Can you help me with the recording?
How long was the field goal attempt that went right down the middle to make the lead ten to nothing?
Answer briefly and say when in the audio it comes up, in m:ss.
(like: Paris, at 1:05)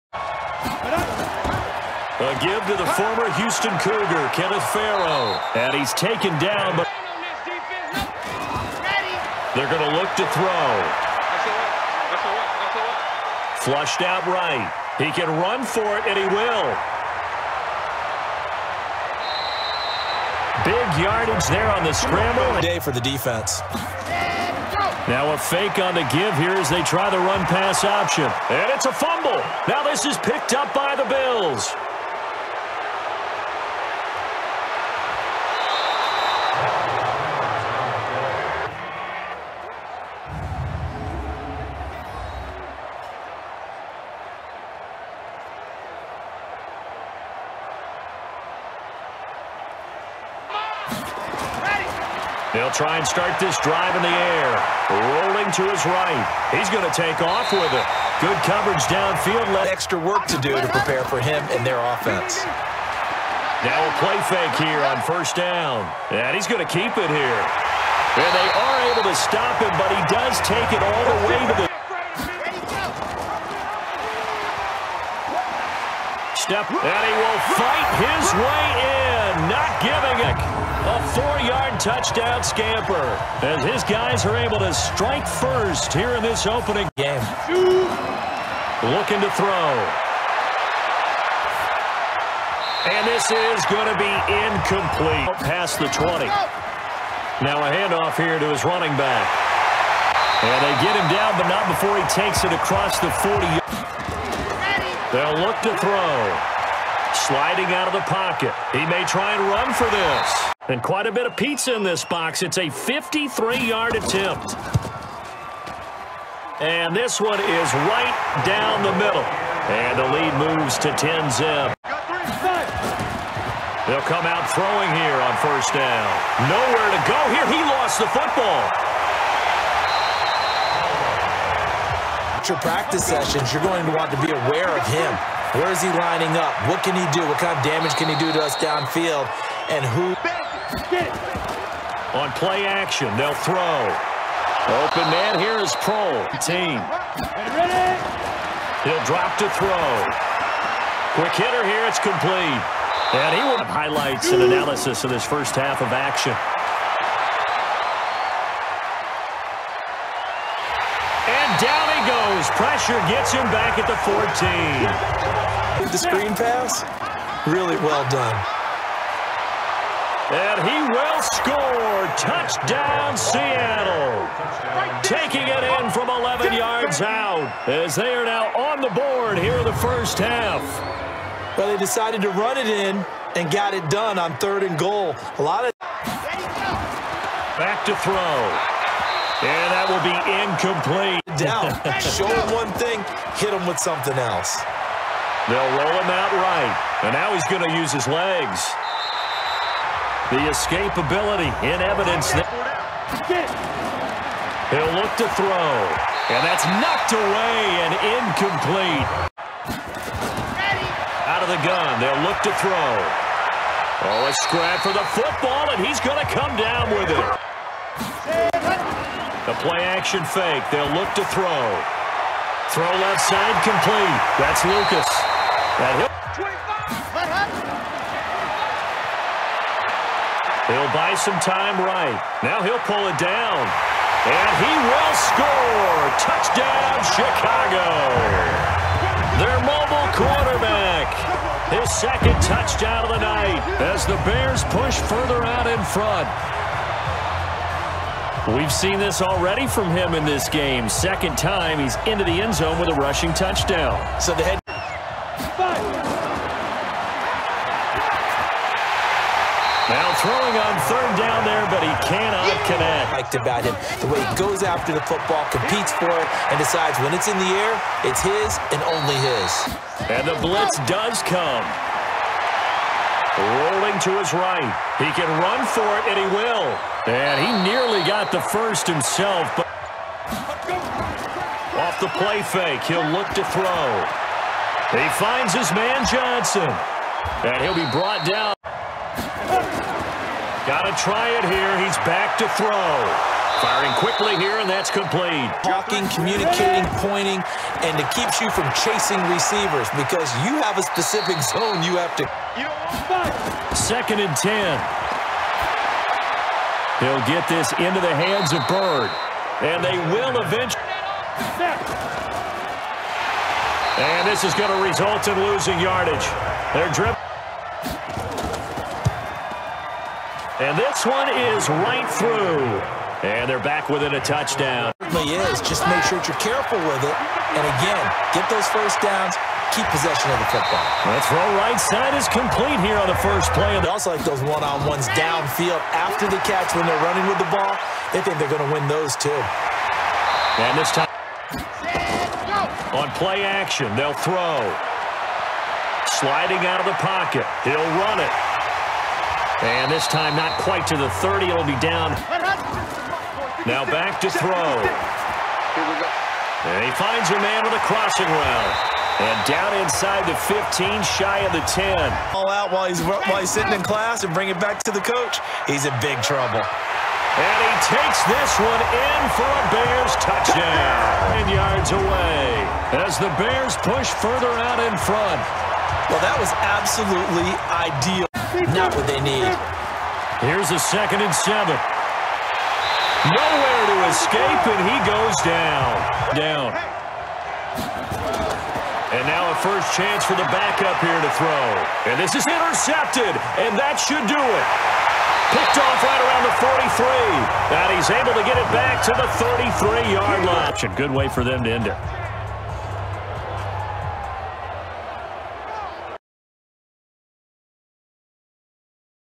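53 yards, at 1:52.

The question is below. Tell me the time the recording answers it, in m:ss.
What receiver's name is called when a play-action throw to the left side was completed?
3:44.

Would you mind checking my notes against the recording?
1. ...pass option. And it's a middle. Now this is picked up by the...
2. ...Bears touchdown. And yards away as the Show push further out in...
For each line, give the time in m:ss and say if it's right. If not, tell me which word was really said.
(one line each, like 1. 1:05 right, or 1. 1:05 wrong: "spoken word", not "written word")
1. 0:27 wrong: "fumble", not "middle"
2. 6:09 wrong: "Bears", not "Show".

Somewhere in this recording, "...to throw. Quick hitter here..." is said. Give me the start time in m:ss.
2:29.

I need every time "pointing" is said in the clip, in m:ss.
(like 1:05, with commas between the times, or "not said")
4:56.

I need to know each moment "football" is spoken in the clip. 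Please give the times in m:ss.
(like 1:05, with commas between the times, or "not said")
2:08, 3:35, 4:25, 5:30.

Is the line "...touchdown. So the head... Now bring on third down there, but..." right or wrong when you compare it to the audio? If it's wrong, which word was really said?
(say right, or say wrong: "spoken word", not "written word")
wrong: "throwing", not "bring".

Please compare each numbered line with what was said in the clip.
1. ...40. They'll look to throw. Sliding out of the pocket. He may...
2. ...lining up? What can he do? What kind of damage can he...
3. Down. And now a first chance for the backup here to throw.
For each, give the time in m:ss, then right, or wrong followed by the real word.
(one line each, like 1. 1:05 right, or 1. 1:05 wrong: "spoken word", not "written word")
1. 1:43 right
2. 2:15 right
3. 6:26 right.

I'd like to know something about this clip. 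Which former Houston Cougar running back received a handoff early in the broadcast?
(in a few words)
Kenneth Farrow.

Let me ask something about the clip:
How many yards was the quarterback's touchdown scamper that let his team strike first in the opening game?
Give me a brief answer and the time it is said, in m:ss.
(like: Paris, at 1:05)
4, at 1:21.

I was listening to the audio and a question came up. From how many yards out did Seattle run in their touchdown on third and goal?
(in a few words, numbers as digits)
11.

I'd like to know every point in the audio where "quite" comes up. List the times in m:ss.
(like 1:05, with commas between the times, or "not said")
1:50, 5:50.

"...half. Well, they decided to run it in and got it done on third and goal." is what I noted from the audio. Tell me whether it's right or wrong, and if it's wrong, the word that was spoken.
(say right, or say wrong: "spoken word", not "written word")
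right.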